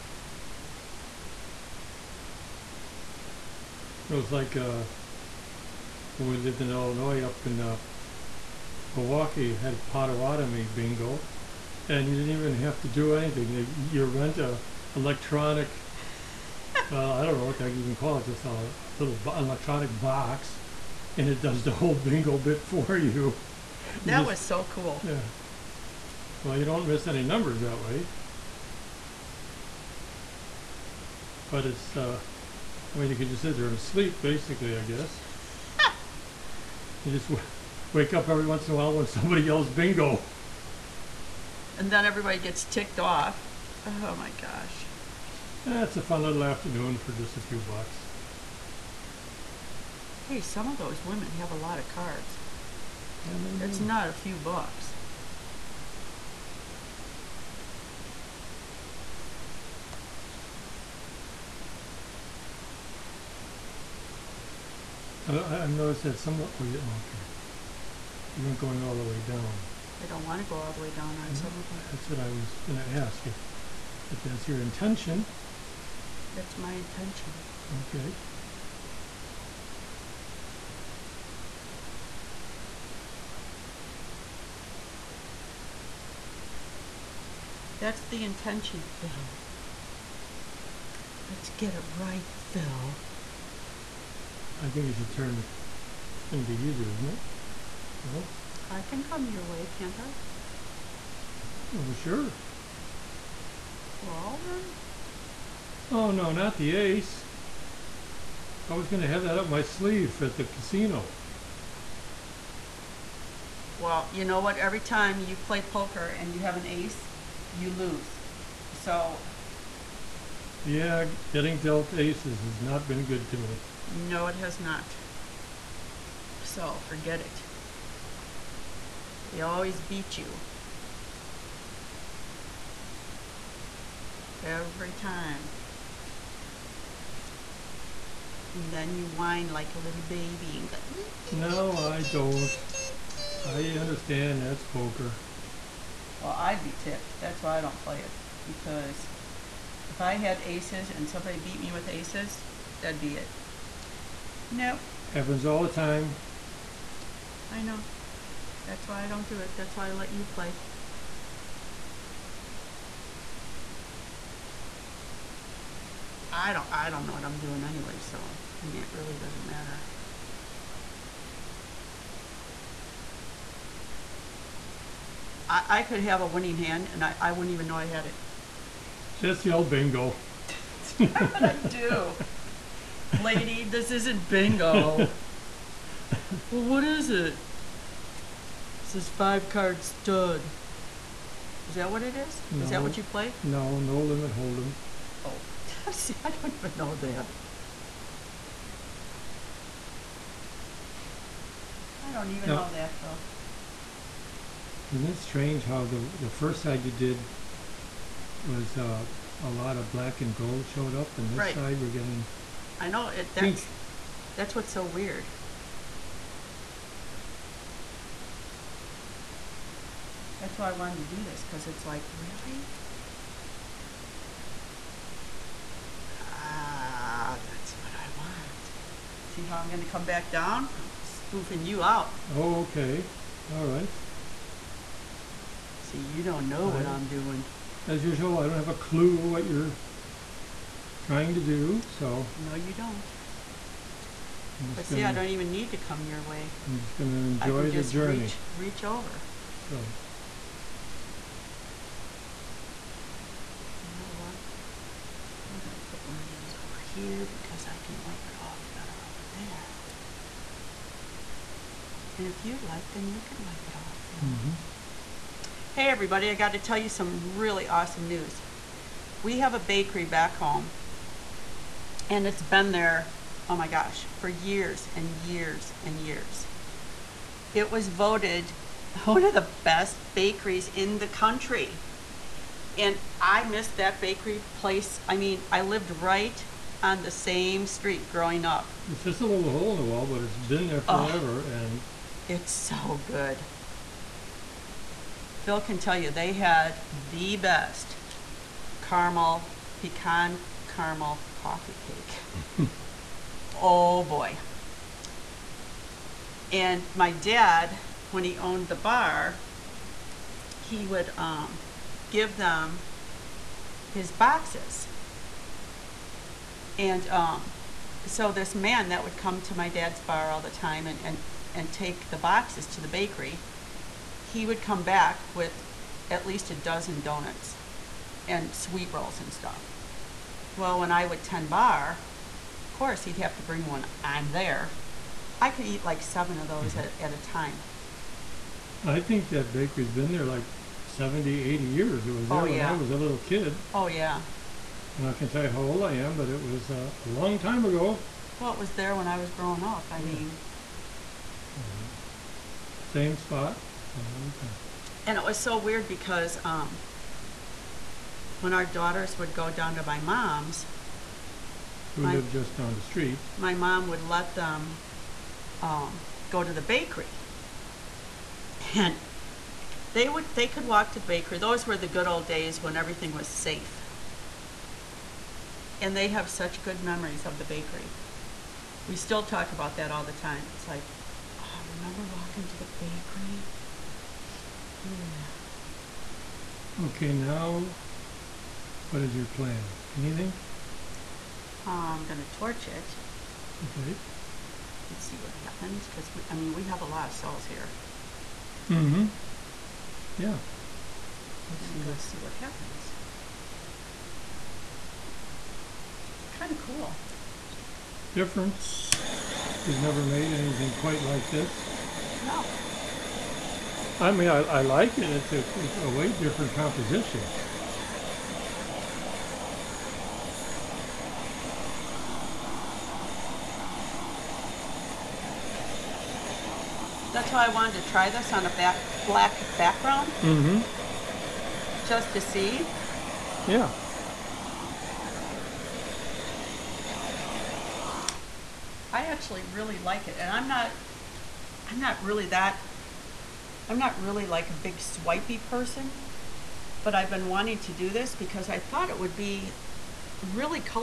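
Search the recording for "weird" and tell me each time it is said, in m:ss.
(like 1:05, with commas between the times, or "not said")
3:34, 5:55.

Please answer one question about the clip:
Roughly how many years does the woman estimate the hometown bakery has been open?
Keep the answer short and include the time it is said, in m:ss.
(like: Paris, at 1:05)
70 to 80 years, at 5:40.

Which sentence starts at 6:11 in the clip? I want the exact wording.
Those were the good old days when everything was safe, and they have such good memories of the bakery.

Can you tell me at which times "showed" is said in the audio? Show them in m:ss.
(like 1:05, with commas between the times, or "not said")
3:30.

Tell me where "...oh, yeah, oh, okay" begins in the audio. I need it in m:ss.
1:06.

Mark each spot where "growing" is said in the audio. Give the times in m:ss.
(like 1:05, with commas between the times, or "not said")
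4:48, 5:49.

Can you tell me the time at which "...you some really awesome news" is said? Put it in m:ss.
4:26.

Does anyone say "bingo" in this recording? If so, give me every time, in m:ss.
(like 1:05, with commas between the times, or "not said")
0:10, 0:21, 0:39, 2:59, 3:04.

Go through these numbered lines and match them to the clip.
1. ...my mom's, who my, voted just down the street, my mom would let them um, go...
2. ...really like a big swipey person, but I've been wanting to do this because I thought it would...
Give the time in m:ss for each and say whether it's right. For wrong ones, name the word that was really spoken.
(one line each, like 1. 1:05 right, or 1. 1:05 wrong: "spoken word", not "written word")
1. 5:59 wrong: "lived", not "voted"
2. 7:24 right.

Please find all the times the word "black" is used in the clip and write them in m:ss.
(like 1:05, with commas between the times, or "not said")
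3:29, 7:09.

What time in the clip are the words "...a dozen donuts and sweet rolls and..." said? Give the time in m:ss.
5:26.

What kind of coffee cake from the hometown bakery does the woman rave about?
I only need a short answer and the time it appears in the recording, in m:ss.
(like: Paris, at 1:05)
Pecan caramel coffee cake, at 4:59.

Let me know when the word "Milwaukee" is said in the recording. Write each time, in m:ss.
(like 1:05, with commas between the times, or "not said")
0:08.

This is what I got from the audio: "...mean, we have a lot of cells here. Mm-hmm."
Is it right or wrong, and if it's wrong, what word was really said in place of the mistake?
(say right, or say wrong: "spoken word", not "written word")
right.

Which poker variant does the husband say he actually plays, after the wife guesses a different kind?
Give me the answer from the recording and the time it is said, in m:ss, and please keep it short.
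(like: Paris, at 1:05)
No limit hold'em, at 3:13.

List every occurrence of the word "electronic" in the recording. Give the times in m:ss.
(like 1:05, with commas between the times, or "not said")
0:14, 0:19.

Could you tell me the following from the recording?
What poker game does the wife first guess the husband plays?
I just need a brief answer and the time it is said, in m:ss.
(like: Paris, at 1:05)
Five card stud, at 3:09.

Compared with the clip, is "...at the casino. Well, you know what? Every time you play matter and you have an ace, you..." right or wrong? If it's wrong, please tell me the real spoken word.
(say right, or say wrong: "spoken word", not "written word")
wrong: "poker", not "matter".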